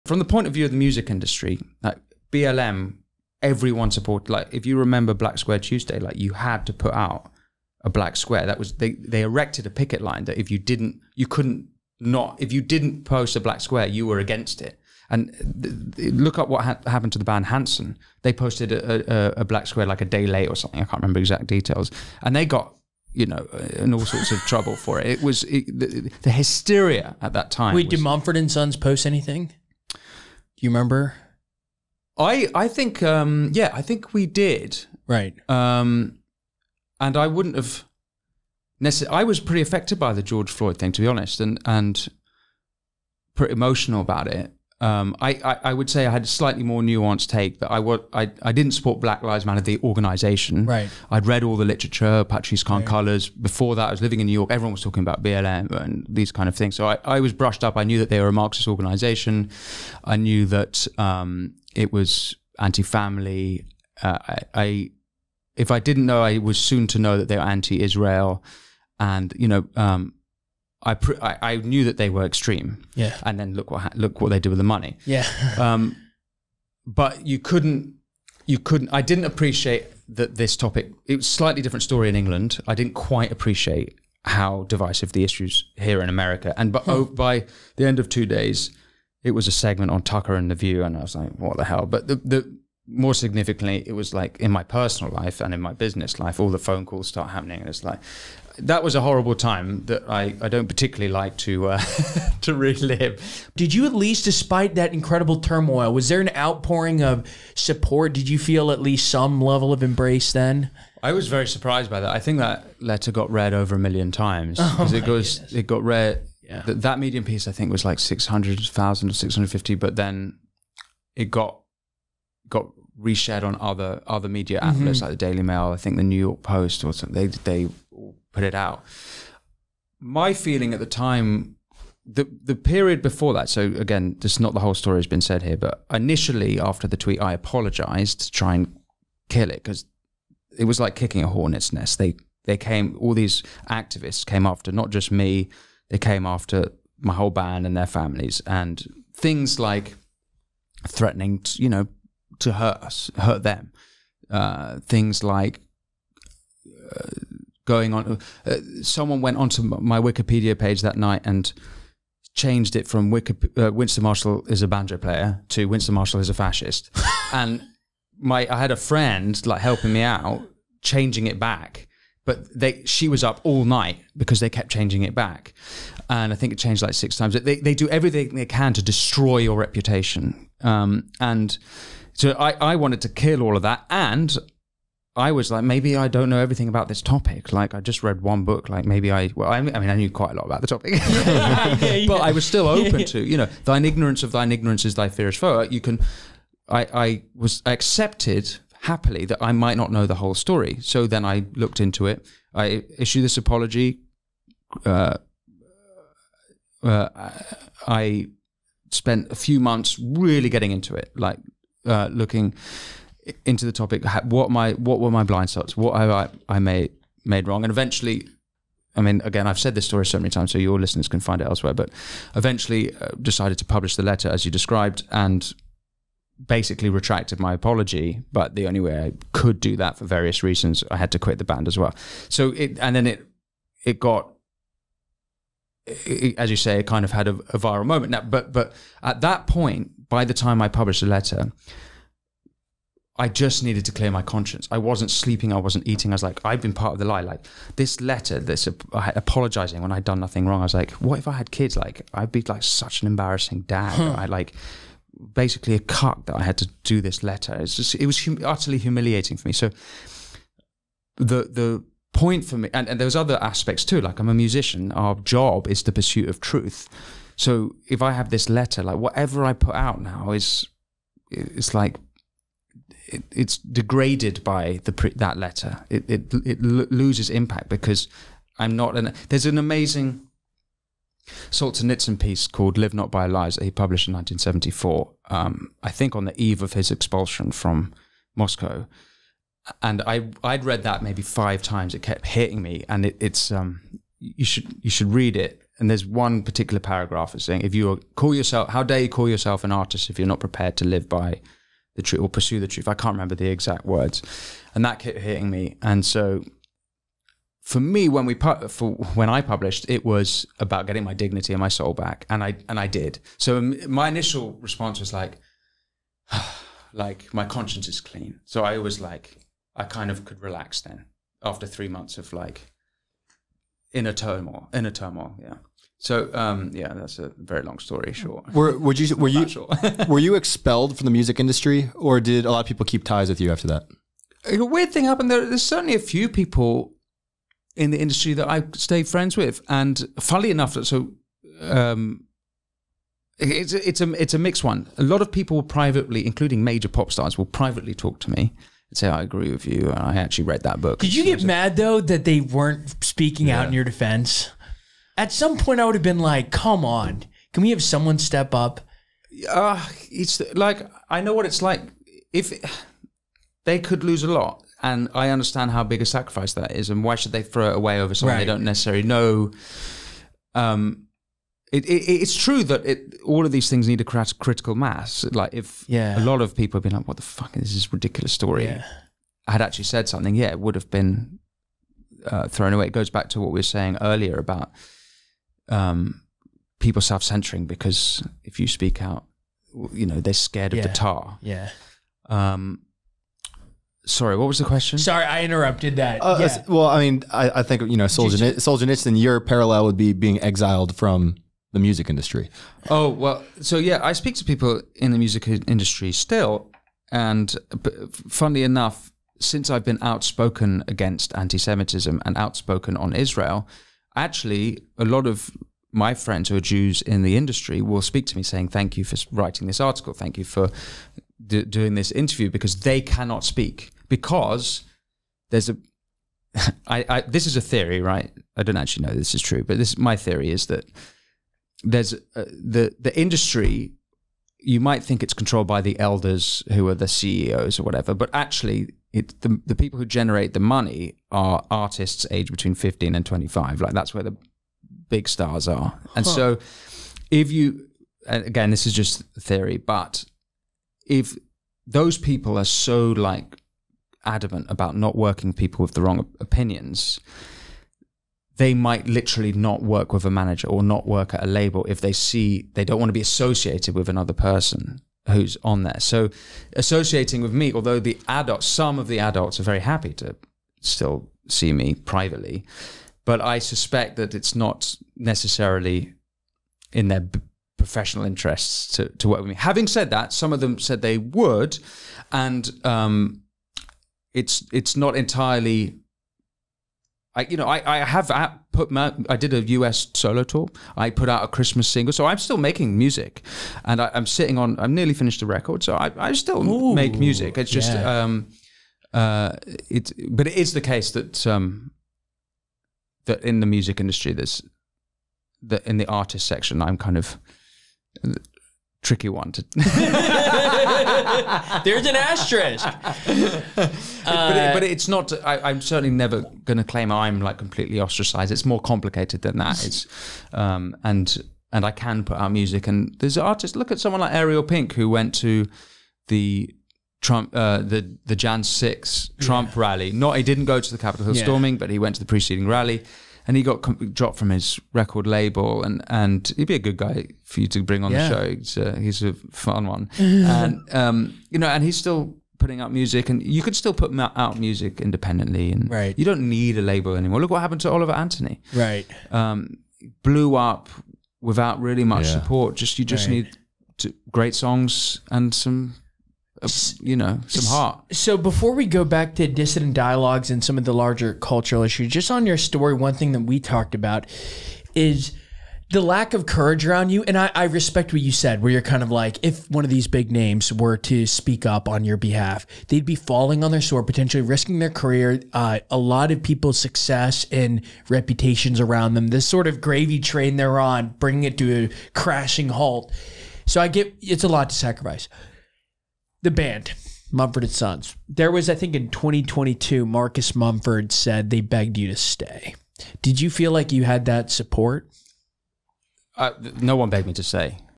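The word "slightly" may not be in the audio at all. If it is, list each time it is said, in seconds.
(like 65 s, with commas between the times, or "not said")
46 s, 81 s.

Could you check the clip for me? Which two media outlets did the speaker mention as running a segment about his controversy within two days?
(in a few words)
Tucker and the View.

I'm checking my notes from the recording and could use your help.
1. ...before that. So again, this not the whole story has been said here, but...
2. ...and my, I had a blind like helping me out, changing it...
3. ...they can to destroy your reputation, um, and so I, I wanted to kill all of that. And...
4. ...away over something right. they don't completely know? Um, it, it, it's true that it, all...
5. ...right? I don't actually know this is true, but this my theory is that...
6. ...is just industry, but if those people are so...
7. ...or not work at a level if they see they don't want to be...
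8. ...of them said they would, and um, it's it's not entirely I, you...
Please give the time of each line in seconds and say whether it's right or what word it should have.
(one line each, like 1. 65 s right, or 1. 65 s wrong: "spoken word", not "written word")
1. 133 s right
2. 167 s wrong: "friend", not "blind"
3. 178 s right
4. 367 s wrong: "necessarily", not "completely"
5. 428 s right
6. 448 s wrong: "theory", not "industry"
7. 460 s wrong: "label", not "level"
8. 480 s right.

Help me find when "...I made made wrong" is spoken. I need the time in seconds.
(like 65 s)
216 s.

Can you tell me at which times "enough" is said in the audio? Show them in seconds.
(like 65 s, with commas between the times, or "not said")
340 s, 408 s.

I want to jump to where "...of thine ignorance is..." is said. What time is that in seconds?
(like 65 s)
194 s.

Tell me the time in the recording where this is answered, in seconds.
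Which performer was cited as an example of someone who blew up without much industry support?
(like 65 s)
547 s.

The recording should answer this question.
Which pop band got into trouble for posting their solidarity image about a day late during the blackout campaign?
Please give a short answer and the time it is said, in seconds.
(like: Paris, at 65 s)
Hanson, at 17 s.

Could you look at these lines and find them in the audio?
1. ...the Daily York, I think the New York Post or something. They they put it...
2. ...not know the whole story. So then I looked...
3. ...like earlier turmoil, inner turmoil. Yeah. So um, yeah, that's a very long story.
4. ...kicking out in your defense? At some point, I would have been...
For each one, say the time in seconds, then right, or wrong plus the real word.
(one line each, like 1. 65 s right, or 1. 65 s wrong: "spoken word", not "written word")
1. 125 s wrong: "Mail", not "York"
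2. 199 s right
3. 322 s wrong: "inner", not "earlier"
4. 353 s wrong: "speaking", not "kicking".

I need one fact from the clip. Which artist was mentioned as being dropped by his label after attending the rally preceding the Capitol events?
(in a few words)
Ariel Pink.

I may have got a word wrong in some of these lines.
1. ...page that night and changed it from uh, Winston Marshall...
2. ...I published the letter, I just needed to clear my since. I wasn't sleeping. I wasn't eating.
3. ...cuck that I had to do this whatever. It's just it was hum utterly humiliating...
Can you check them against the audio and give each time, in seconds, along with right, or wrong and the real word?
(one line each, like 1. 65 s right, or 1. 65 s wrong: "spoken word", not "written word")
1. 160 s right
2. 240 s wrong: "conscience", not "since"
3. 255 s wrong: "letter", not "whatever".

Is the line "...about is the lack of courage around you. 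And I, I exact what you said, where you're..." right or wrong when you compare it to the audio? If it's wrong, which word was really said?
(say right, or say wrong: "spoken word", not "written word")
wrong: "respect", not "exact".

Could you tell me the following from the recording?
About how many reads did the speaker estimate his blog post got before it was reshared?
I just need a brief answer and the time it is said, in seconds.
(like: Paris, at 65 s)
600,000, at 117 s.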